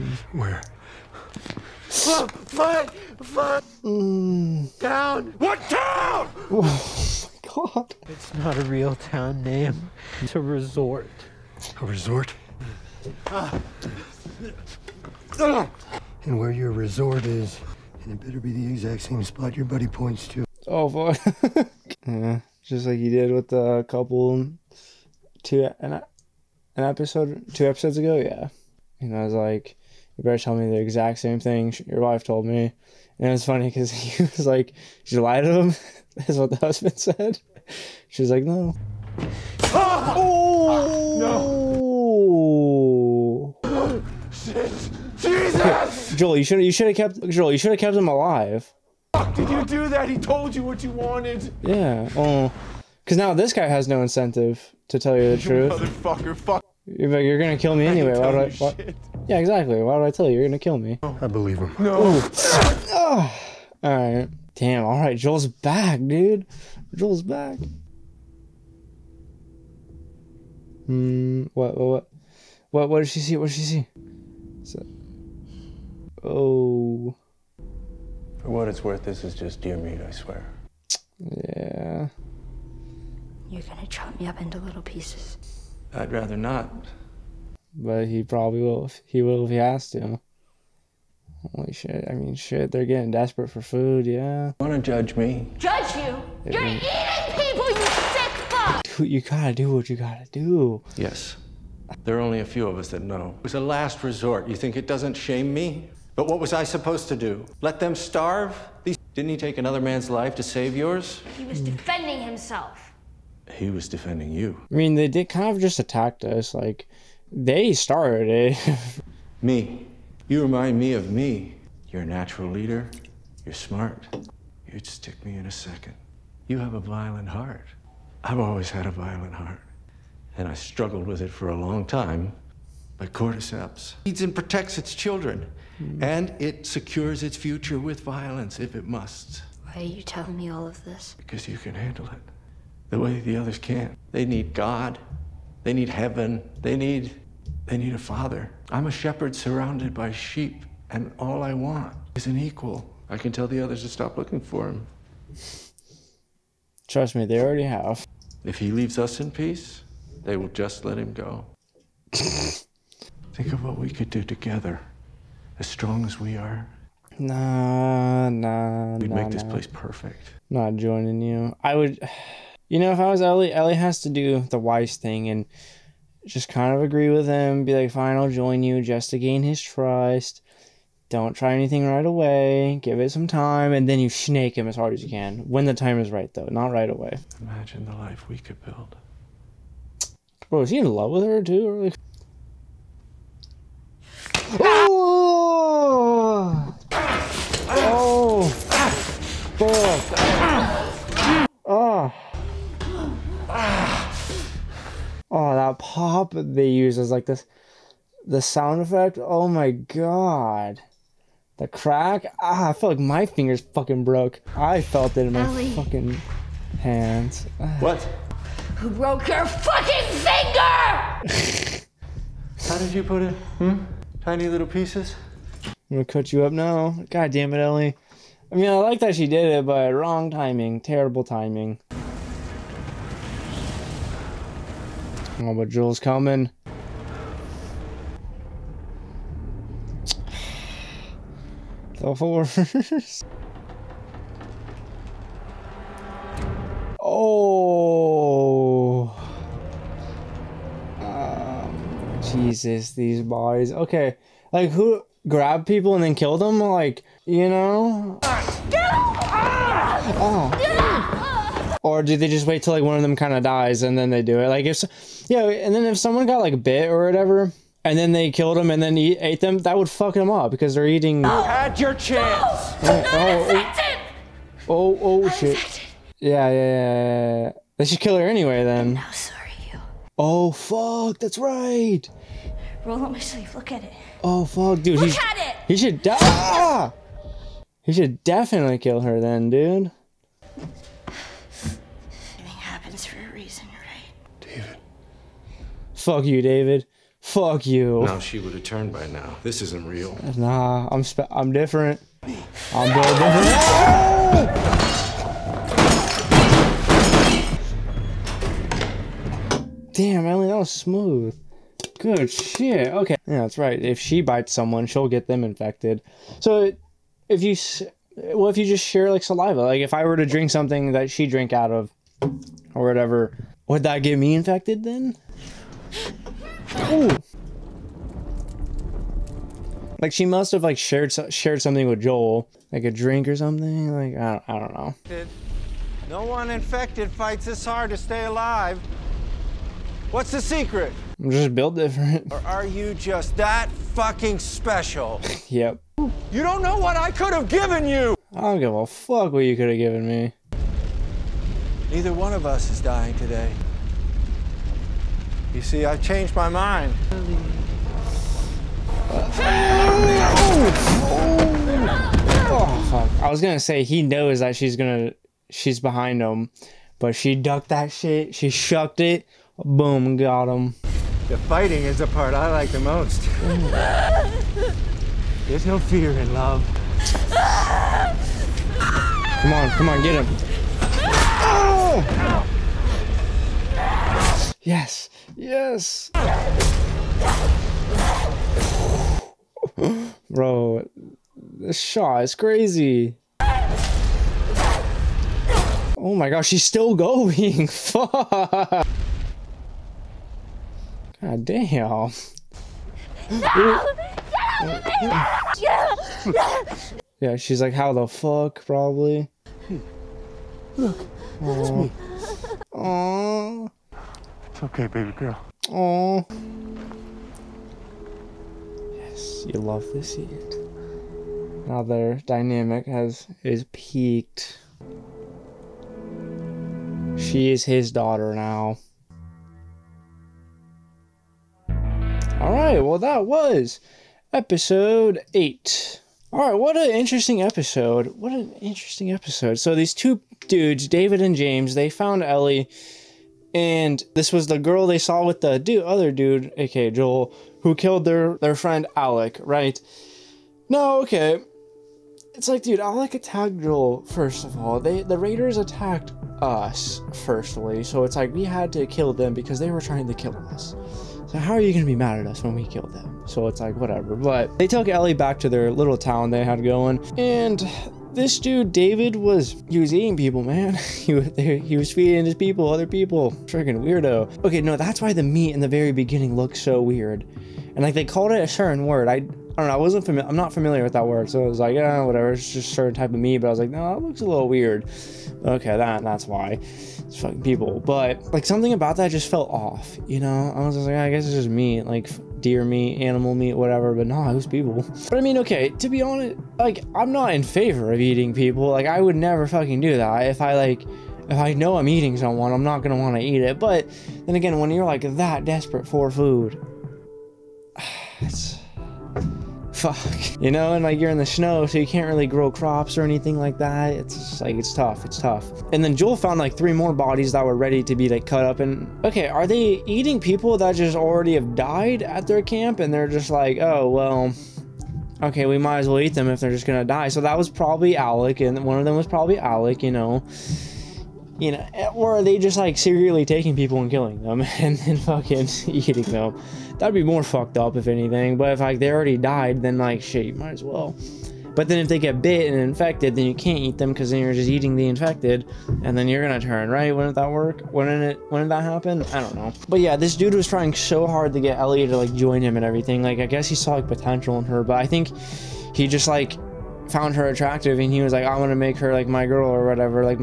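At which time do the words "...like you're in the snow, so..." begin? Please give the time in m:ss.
8:30.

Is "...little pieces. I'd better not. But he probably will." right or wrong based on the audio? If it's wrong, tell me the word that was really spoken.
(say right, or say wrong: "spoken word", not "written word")
wrong: "rather", not "better".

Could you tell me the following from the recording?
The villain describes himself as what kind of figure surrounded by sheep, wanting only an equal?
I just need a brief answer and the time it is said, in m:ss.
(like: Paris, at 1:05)
A shepherd, at 2:28.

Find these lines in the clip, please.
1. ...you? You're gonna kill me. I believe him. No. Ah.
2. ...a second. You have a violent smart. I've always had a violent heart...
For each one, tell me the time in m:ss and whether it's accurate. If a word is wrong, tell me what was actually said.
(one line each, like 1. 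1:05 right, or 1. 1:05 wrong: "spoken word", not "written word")
1. 1:00 right
2. 2:05 wrong: "heart", not "smart".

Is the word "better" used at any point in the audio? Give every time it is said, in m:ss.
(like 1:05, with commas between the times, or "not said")
0:18, 0:30.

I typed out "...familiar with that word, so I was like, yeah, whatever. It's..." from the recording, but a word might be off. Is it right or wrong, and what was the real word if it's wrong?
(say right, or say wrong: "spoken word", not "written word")
right.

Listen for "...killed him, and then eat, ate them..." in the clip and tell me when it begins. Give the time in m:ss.
4:28.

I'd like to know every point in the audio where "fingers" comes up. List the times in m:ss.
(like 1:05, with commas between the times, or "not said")
3:33, 3:41.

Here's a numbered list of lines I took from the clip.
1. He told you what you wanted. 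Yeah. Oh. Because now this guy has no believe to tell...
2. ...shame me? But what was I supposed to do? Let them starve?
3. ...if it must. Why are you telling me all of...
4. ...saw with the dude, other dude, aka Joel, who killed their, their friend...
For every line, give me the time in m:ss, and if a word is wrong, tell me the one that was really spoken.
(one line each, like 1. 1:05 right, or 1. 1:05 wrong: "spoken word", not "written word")
1. 0:50 wrong: "incentive", not "believe"
2. 1:45 right
3. 2:18 right
4. 7:24 right.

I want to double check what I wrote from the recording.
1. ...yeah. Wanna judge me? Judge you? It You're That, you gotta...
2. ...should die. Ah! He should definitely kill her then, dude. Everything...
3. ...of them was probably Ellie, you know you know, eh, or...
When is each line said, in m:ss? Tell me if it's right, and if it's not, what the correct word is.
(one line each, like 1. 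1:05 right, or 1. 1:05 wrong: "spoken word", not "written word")
1. 1:34 wrong: "Dude", not "That"
2. 4:45 right
3. 8:48 wrong: "Alec", not "Ellie".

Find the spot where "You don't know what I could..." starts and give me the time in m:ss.
5:46.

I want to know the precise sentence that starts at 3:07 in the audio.
Imagine the life we could build.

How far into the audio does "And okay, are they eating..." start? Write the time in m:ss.
8:38.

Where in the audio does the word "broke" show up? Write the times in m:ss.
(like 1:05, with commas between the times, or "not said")
3:34, 3:38.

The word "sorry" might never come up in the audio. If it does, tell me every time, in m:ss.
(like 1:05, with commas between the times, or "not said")
4:39.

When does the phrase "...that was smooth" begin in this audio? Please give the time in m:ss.
5:10.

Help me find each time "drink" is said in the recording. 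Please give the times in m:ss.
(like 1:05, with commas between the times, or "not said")
5:20, 5:32.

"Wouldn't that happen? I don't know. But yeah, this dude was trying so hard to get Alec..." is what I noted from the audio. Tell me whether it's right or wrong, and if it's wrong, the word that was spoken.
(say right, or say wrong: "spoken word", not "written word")
wrong: "Ellie", not "Alec".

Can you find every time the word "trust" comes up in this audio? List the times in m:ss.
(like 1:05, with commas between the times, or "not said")
2:36, 2:59.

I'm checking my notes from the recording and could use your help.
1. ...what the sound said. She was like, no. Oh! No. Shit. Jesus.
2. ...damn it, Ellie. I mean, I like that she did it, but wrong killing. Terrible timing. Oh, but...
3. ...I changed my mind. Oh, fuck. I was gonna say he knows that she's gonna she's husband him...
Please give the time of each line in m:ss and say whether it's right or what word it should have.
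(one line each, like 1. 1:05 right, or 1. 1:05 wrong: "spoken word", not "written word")
1. 0:36 wrong: "husband", not "sound"
2. 3:47 wrong: "timing", not "killing"
3. 5:55 wrong: "behind", not "husband".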